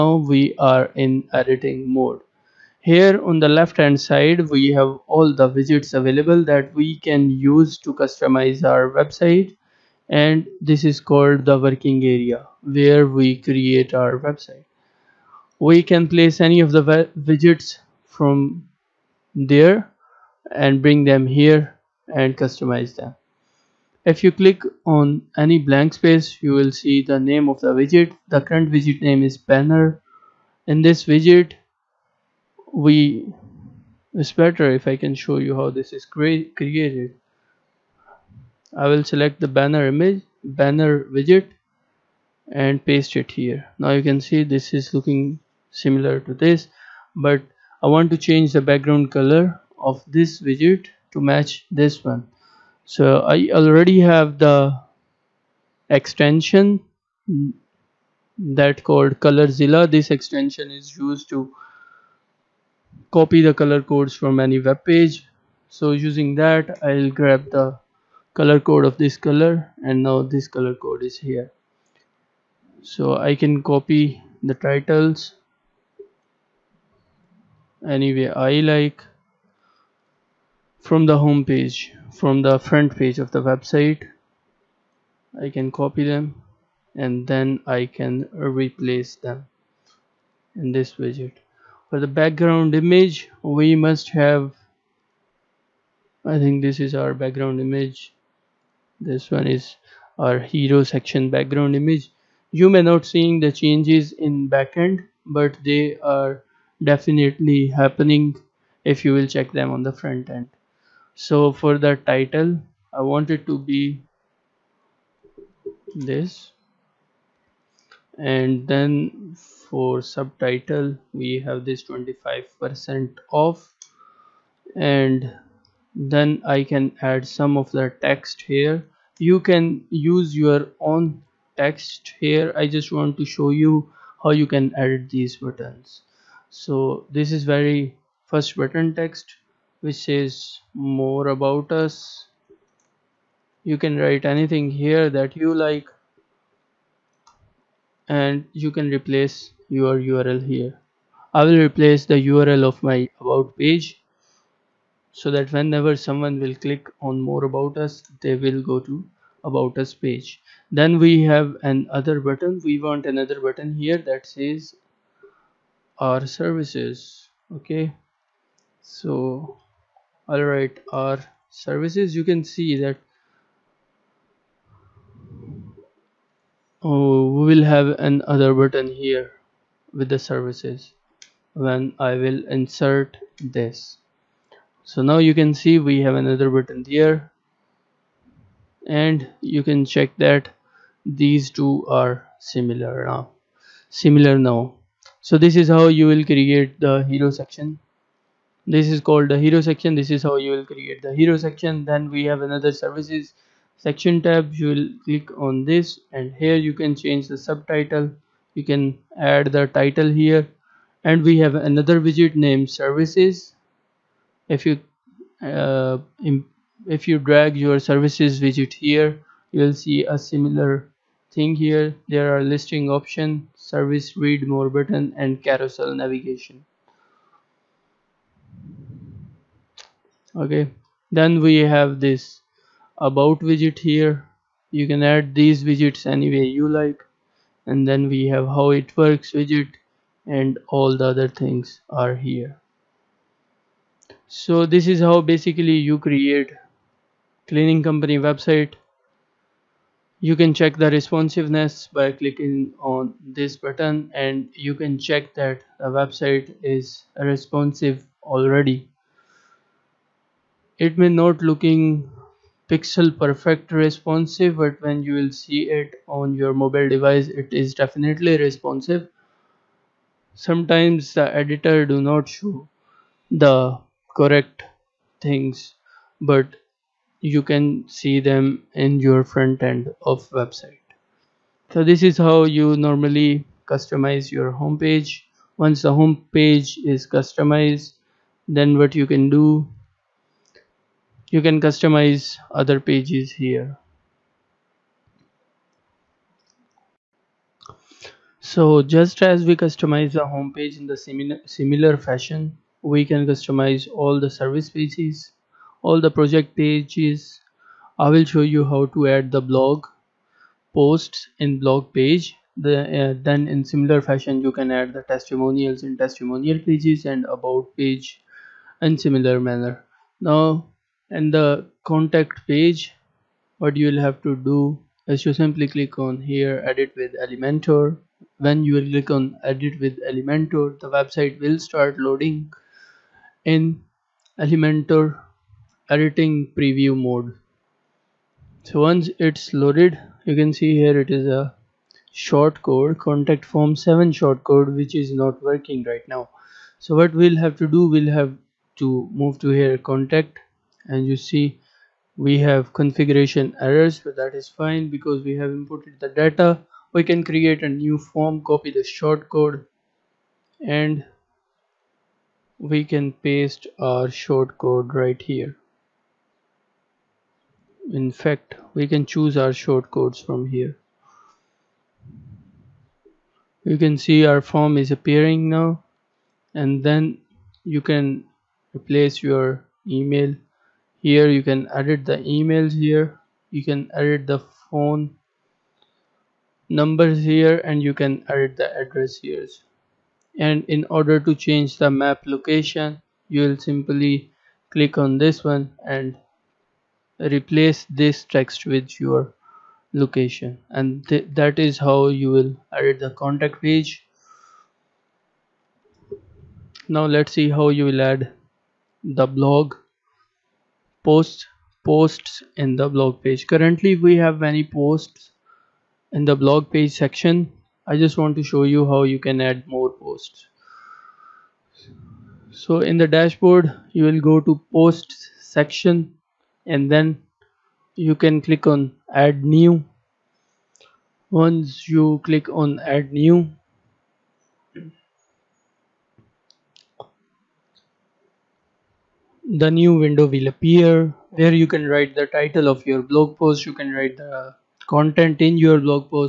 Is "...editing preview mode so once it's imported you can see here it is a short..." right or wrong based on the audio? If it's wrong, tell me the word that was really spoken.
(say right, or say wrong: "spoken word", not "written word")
wrong: "loaded", not "imported".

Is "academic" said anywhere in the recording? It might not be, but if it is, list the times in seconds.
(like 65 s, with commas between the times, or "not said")
not said.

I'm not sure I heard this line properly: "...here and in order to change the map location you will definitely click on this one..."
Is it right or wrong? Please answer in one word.
wrong.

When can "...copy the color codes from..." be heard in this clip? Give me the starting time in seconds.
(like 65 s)
63 s.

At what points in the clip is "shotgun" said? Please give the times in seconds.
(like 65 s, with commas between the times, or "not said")
not said.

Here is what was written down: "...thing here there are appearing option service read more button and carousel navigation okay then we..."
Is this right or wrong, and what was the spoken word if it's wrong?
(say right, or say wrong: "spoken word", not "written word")
wrong: "listing", not "appearing".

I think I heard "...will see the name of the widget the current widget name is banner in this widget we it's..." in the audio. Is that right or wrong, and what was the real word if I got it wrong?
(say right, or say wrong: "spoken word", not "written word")
right.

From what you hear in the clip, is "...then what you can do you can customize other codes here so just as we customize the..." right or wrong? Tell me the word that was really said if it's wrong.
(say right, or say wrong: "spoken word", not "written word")
wrong: "pages", not "codes".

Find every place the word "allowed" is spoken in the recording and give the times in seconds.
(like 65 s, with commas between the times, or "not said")
not said.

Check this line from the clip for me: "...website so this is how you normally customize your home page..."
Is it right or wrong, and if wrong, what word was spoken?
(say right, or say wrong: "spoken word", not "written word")
right.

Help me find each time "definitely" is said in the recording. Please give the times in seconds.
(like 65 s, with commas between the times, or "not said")
106 s, 267 s.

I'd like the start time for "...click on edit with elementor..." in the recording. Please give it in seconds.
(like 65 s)
328 s.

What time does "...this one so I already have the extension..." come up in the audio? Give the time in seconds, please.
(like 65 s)
51 s.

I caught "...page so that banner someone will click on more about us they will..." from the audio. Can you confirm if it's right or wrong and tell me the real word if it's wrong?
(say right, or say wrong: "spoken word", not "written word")
wrong: "whenever", not "banner".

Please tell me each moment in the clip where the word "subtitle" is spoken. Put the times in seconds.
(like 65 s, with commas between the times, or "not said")
120 s, 207 s.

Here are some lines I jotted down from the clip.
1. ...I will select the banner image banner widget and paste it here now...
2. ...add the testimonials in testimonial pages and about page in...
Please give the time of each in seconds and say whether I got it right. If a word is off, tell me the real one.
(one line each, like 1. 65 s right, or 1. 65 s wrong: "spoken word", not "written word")
1. 38 s right
2. 314 s right.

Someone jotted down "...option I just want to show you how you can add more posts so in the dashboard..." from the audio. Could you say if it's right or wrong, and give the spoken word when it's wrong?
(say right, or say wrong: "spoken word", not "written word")
wrong: "section", not "option".